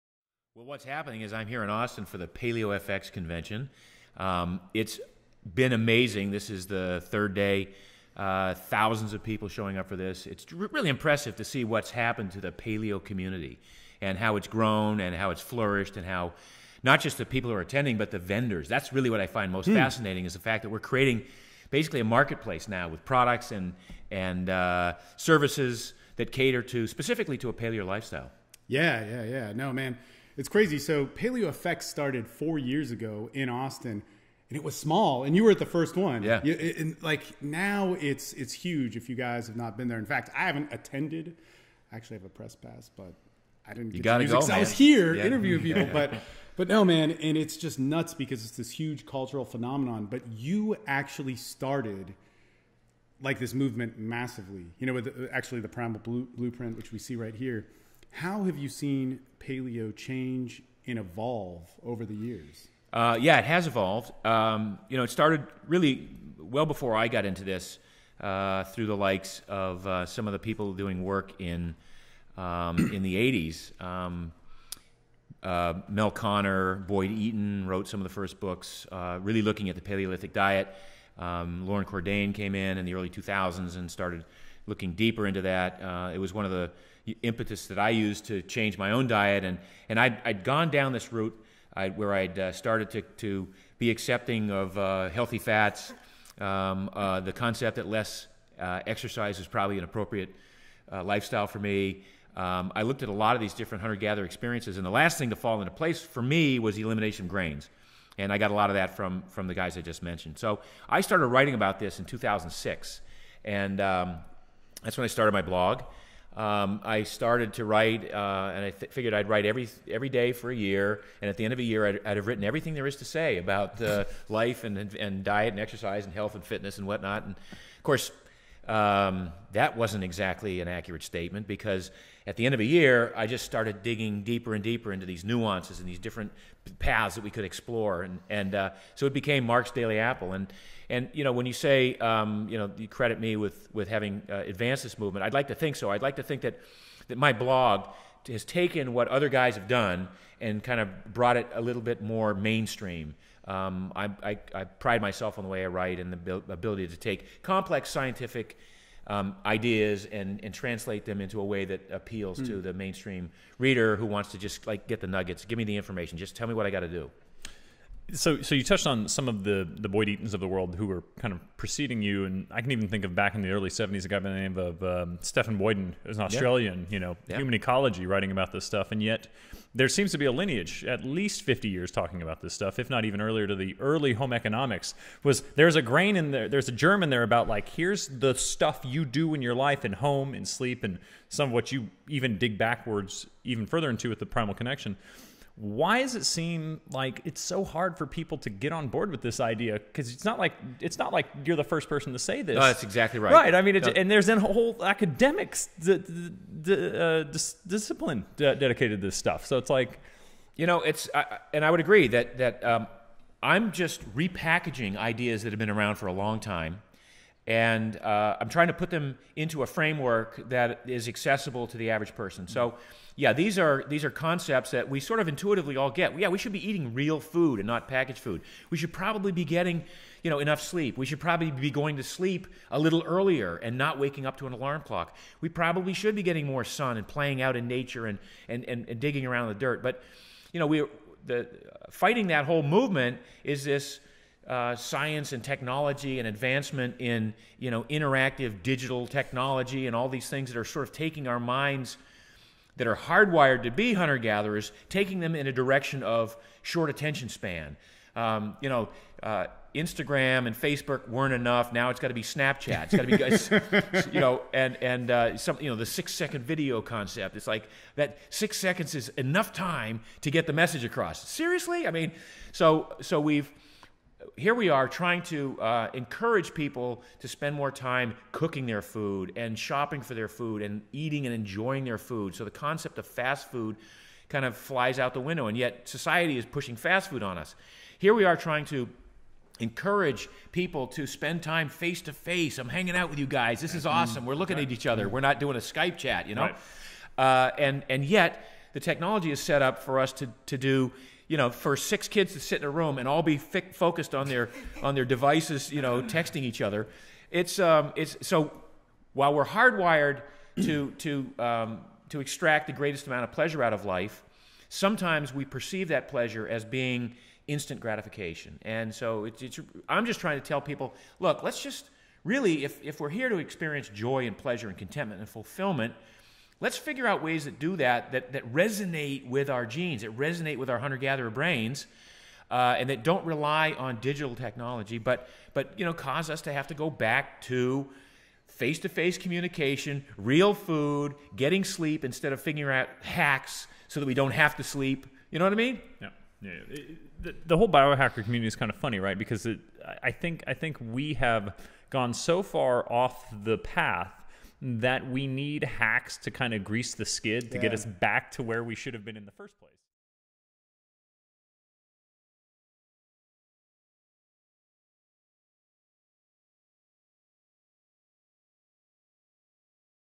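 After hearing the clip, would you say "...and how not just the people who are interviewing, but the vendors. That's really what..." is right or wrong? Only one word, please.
wrong.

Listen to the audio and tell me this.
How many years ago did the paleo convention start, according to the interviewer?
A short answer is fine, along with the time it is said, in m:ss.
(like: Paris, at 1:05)
4, at 0:32.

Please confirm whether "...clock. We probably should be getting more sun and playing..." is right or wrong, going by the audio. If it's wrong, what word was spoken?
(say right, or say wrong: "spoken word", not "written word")
right.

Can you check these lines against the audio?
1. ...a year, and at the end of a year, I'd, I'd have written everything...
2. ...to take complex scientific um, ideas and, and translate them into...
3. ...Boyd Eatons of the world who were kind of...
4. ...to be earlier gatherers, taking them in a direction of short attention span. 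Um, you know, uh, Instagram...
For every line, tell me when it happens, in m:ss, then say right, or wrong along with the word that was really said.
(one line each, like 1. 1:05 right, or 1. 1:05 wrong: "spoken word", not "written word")
1. 2:00 right
2. 2:36 right
3. 2:49 right
4. 4:13 wrong: "hunter", not "earlier".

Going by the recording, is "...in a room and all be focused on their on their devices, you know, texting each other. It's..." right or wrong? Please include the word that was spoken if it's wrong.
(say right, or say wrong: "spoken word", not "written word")
right.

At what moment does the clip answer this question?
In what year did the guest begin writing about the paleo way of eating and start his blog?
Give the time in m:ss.
1:52.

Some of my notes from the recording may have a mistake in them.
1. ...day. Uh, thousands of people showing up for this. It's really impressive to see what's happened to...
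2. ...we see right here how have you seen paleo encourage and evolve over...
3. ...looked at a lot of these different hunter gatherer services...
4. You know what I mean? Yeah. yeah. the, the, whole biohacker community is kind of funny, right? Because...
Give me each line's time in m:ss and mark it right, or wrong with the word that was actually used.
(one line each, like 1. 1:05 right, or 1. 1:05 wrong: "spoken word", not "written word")
1. 0:07 right
2. 0:56 wrong: "change", not "encourage"
3. 1:42 wrong: "experiences", not "services"
4. 5:45 right.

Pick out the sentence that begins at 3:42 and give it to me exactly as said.
So, yeah, these are these are concepts that we sort of intuitively all get.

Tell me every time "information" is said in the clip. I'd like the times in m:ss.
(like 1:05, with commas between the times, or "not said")
2:45.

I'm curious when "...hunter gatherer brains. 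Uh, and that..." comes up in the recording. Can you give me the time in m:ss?
5:30.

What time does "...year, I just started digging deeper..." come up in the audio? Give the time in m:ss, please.
2:12.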